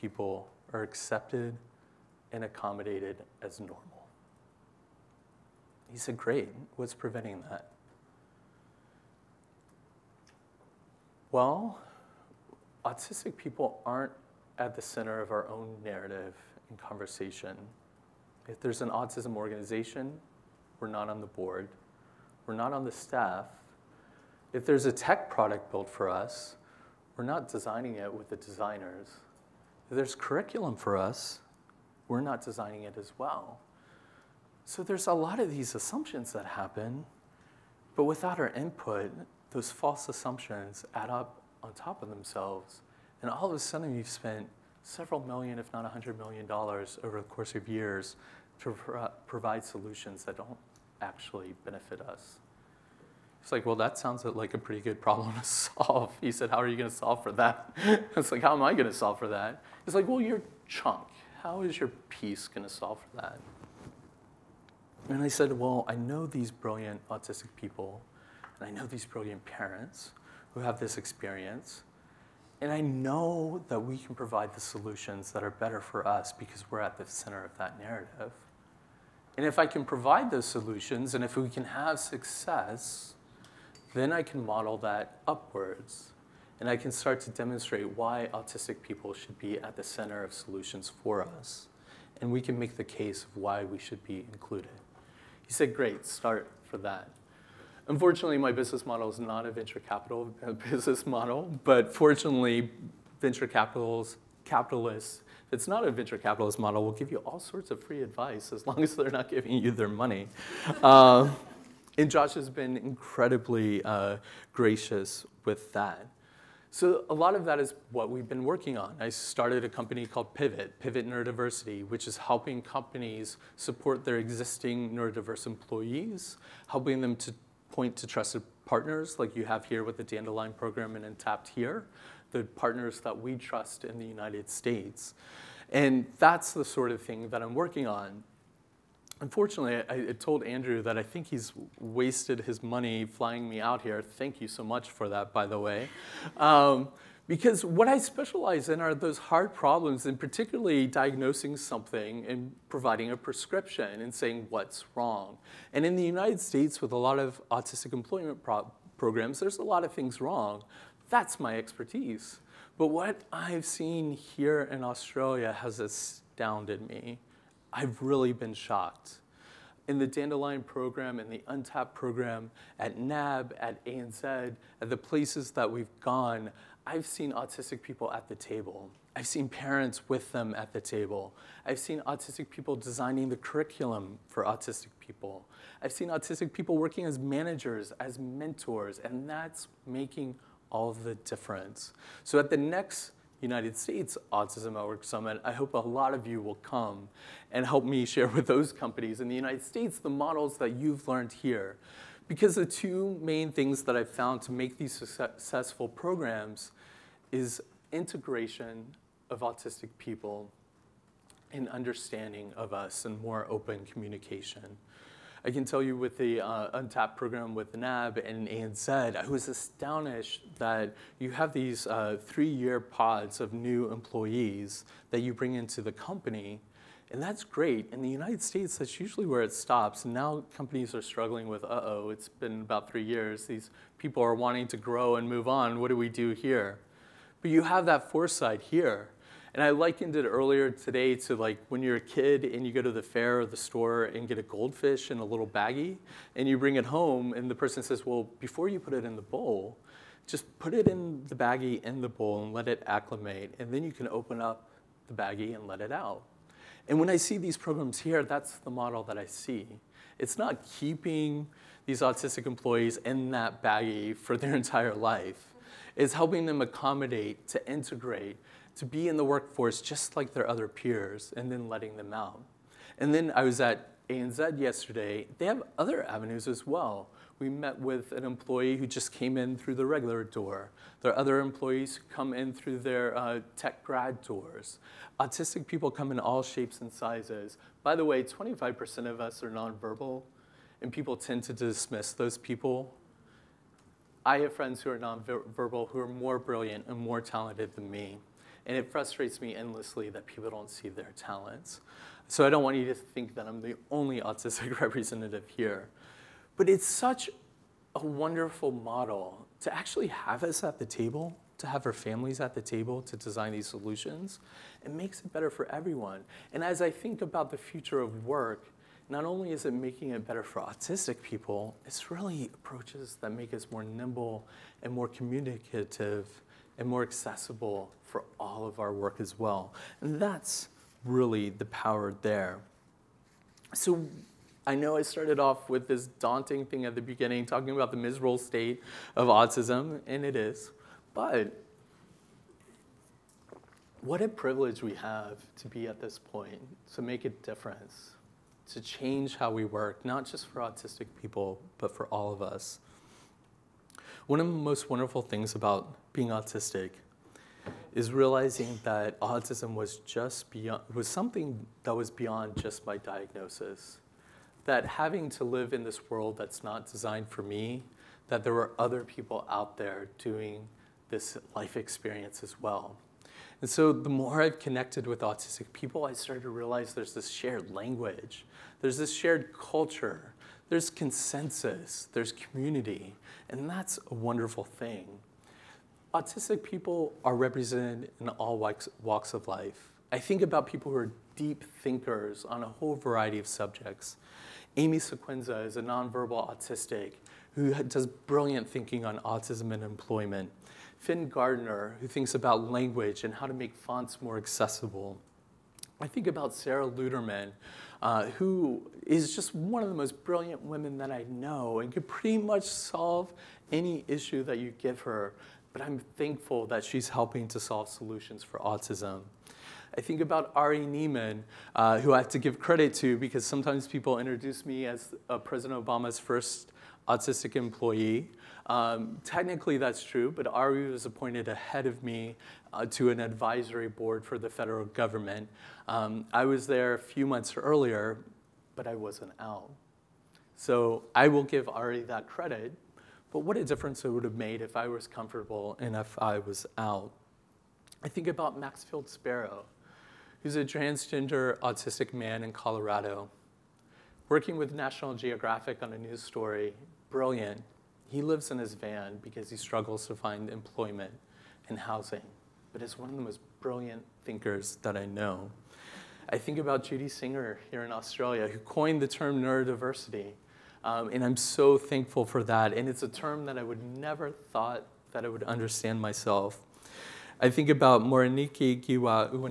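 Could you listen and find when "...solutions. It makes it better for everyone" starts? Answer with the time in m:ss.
5:13.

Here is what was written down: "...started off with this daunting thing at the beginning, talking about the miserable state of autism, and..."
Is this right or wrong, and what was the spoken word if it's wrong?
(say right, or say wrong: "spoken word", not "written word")
right.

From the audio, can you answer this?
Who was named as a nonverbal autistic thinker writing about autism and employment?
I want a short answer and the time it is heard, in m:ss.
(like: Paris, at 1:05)
Amy Sequenzia, at 6:34.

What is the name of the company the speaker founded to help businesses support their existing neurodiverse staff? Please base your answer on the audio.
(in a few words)
Pivot Neurodiversity.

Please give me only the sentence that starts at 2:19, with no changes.
Unfortunately, I, I told Andrew that I think he's wasted his money flying me out here.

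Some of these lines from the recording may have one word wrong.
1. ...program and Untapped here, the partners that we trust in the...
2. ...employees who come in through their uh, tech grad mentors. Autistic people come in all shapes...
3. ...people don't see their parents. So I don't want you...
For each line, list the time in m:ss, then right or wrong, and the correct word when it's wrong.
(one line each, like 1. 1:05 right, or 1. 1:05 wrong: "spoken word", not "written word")
1. 2:10 right
2. 4:41 wrong: "doors", not "mentors"
3. 5:00 wrong: "talents", not "parents".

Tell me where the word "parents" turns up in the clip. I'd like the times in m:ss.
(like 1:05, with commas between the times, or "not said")
1:09, 2:59.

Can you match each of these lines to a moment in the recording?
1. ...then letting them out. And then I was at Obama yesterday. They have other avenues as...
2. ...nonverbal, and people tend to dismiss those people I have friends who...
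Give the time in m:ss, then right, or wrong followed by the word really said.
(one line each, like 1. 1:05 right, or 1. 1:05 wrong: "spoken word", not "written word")
1. 4:31 wrong: "ANZ", not "Obama"
2. 4:49 right.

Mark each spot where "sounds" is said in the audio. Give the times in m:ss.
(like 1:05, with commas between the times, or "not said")
0:53.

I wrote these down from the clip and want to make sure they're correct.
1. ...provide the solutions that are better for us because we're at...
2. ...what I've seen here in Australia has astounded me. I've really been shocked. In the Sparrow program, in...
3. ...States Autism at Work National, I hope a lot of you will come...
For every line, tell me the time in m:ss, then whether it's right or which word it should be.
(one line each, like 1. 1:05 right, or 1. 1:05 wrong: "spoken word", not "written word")
1. 1:14 right
2. 2:42 wrong: "Dandelion", not "Sparrow"
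3. 3:13 wrong: "Summit", not "National".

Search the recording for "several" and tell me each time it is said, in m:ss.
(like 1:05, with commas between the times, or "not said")
0:44.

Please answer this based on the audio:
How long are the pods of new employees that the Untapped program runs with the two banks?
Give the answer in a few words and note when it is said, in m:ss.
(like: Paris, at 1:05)
3 years, at 3:42.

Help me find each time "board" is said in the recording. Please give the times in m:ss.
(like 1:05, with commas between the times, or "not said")
0:21, 7:13.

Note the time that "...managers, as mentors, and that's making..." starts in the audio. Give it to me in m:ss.
3:07.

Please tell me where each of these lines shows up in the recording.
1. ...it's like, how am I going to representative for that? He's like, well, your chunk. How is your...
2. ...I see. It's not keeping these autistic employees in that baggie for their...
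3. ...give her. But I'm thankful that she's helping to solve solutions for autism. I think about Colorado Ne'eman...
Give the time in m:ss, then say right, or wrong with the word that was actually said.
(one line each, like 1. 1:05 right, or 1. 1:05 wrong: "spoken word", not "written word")
1. 0:58 wrong: "solve", not "representative"
2. 4:19 right
3. 6:54 wrong: "Ari", not "Colorado".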